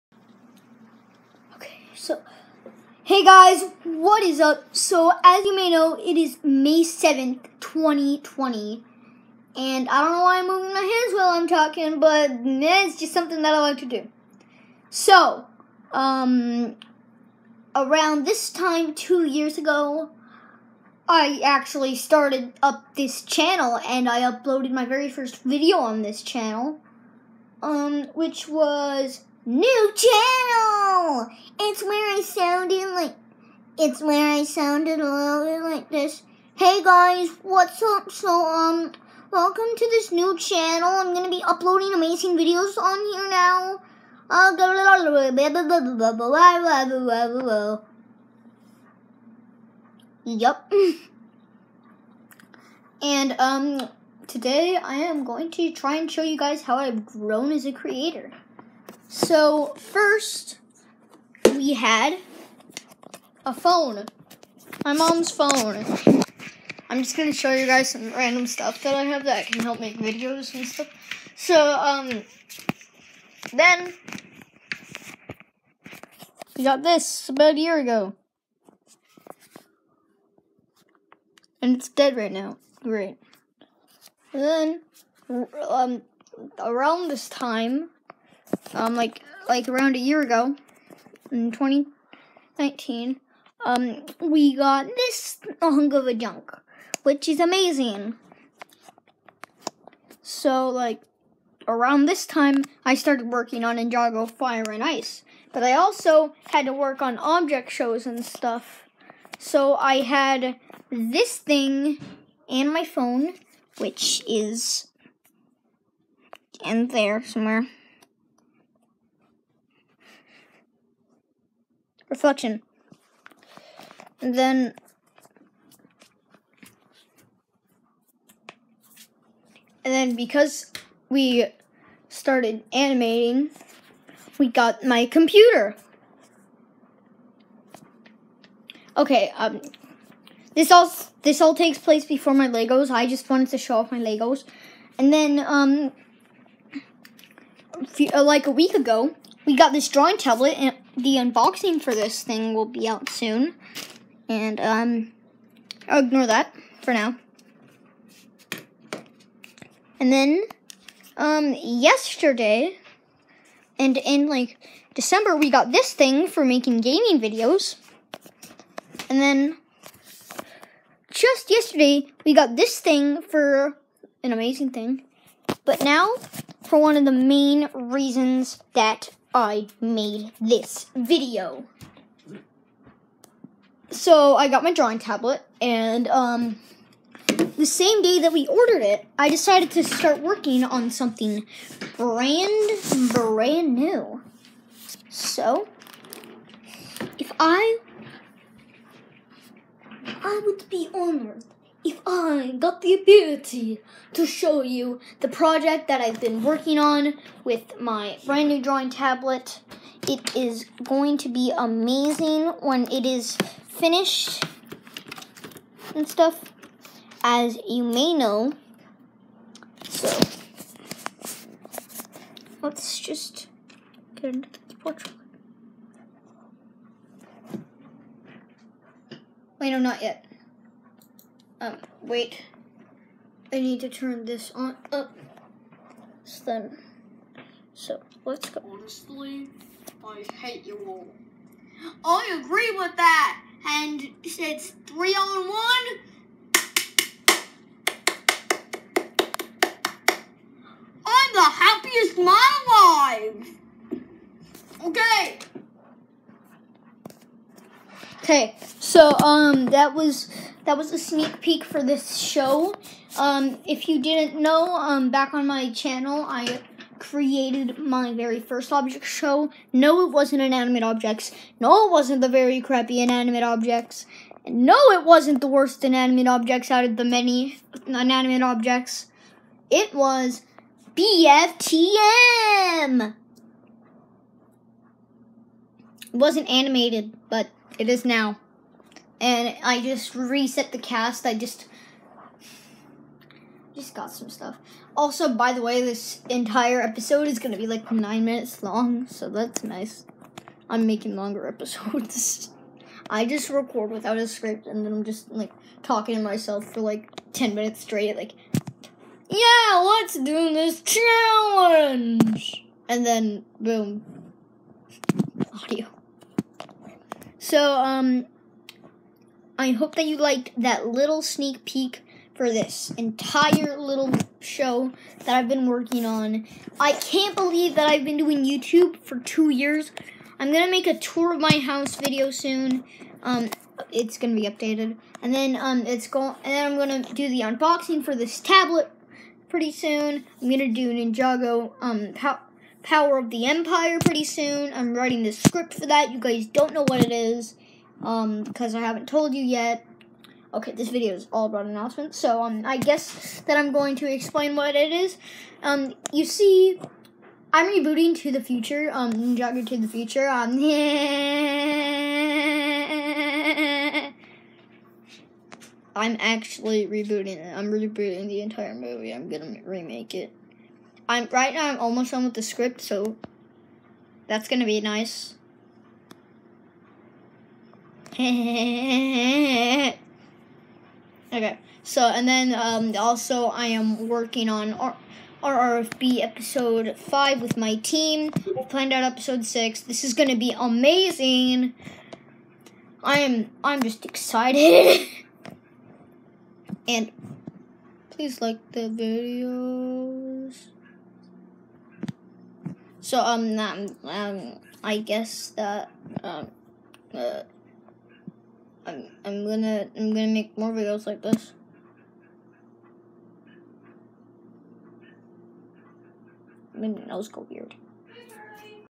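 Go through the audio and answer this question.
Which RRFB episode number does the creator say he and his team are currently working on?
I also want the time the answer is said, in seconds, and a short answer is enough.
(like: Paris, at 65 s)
5, at 386 s.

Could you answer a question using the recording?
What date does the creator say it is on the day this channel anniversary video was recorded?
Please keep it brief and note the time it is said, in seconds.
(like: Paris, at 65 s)
May 7th, 2020, at 6 s.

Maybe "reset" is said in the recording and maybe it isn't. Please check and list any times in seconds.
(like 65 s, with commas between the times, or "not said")
290 s.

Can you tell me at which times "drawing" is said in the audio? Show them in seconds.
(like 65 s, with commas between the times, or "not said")
149 s, 184 s, 208 s.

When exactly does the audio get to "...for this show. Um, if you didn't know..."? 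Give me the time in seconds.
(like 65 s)
261 s.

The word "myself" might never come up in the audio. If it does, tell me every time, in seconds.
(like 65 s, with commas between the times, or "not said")
306 s.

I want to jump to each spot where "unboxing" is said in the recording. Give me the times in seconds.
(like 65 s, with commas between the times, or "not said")
151 s, 337 s.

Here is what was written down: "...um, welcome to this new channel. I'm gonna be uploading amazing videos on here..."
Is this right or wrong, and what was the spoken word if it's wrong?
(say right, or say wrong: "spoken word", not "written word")
right.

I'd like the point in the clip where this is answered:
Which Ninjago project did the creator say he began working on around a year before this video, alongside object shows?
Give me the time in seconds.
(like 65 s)
103 s.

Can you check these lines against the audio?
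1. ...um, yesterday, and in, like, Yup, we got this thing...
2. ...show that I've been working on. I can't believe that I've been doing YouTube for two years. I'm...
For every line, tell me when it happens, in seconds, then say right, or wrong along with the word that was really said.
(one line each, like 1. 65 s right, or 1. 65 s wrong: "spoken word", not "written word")
1. 161 s wrong: "December", not "Yup"
2. 324 s right.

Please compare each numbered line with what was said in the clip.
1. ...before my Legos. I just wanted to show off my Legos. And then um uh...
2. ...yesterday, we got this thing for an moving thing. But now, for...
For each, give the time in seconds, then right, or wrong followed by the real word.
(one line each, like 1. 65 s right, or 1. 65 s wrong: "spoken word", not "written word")
1. 142 s right
2. 171 s wrong: "amazing", not "moving".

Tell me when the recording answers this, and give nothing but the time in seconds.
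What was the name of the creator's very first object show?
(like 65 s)
280 s.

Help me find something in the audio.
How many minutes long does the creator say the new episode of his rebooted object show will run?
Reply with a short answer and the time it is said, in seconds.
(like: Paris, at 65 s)
9, at 297 s.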